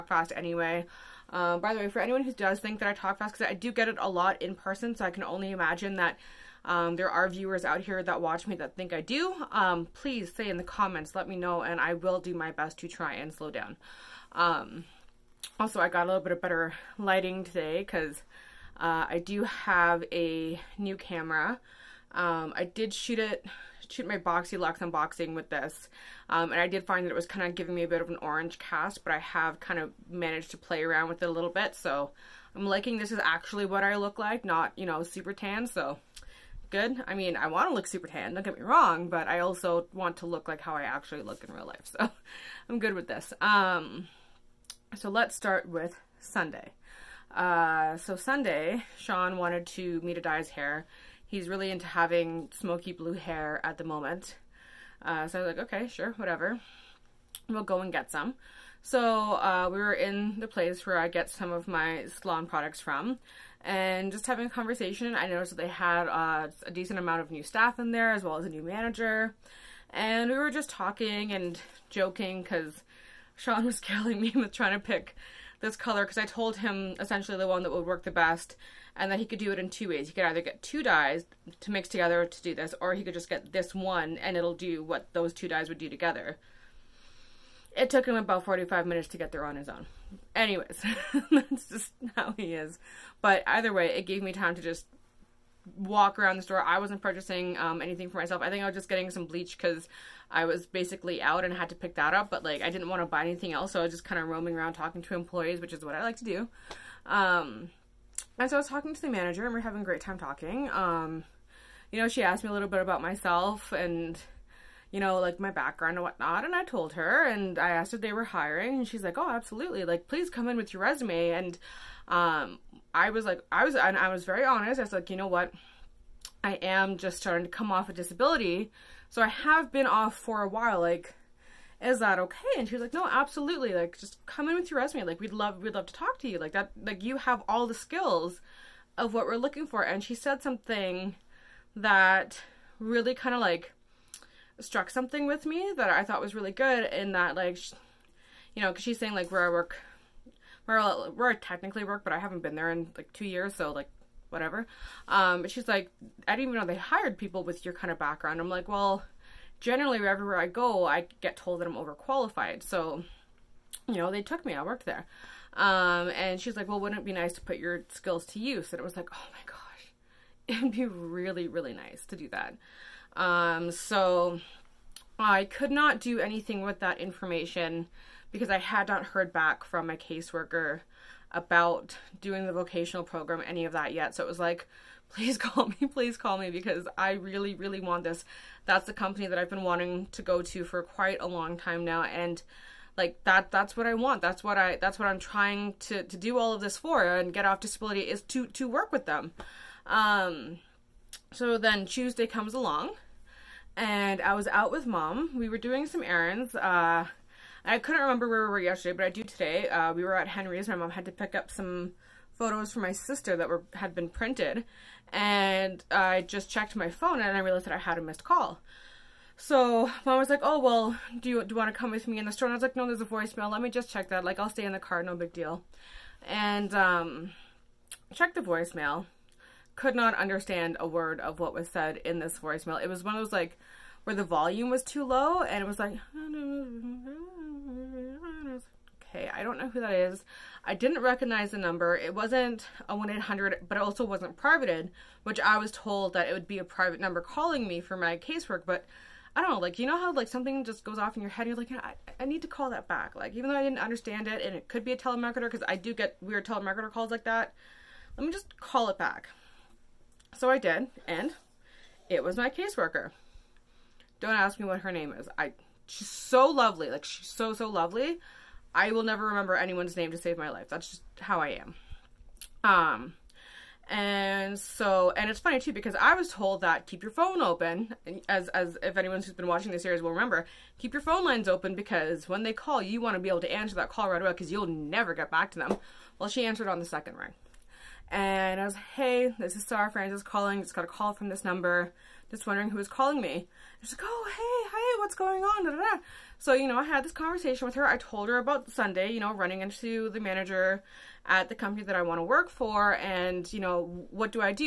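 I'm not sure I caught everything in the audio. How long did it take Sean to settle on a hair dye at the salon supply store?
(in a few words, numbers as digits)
45 minutes.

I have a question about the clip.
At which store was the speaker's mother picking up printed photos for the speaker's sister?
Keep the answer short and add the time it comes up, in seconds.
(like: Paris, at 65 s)
Henry's, at 210 s.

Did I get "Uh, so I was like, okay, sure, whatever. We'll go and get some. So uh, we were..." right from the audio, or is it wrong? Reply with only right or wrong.
right.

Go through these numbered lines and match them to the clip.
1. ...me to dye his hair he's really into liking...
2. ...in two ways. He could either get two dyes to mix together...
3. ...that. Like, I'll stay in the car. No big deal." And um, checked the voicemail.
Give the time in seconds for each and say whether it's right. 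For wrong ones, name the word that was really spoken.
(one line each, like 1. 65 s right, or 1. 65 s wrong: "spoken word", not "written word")
1. 50 s wrong: "having", not "liking"
2. 79 s right
3. 224 s right.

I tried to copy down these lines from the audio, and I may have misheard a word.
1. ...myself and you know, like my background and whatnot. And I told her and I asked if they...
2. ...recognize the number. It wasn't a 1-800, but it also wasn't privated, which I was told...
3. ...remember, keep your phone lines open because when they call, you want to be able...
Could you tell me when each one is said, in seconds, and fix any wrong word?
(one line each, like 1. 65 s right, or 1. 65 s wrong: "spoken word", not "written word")
1. 113 s right
2. 241 s right
3. 280 s right.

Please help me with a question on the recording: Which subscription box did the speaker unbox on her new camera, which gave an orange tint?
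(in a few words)
BoxyLuxe.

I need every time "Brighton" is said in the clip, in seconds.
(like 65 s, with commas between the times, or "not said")
not said.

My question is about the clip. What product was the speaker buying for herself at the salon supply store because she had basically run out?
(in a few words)
Bleach.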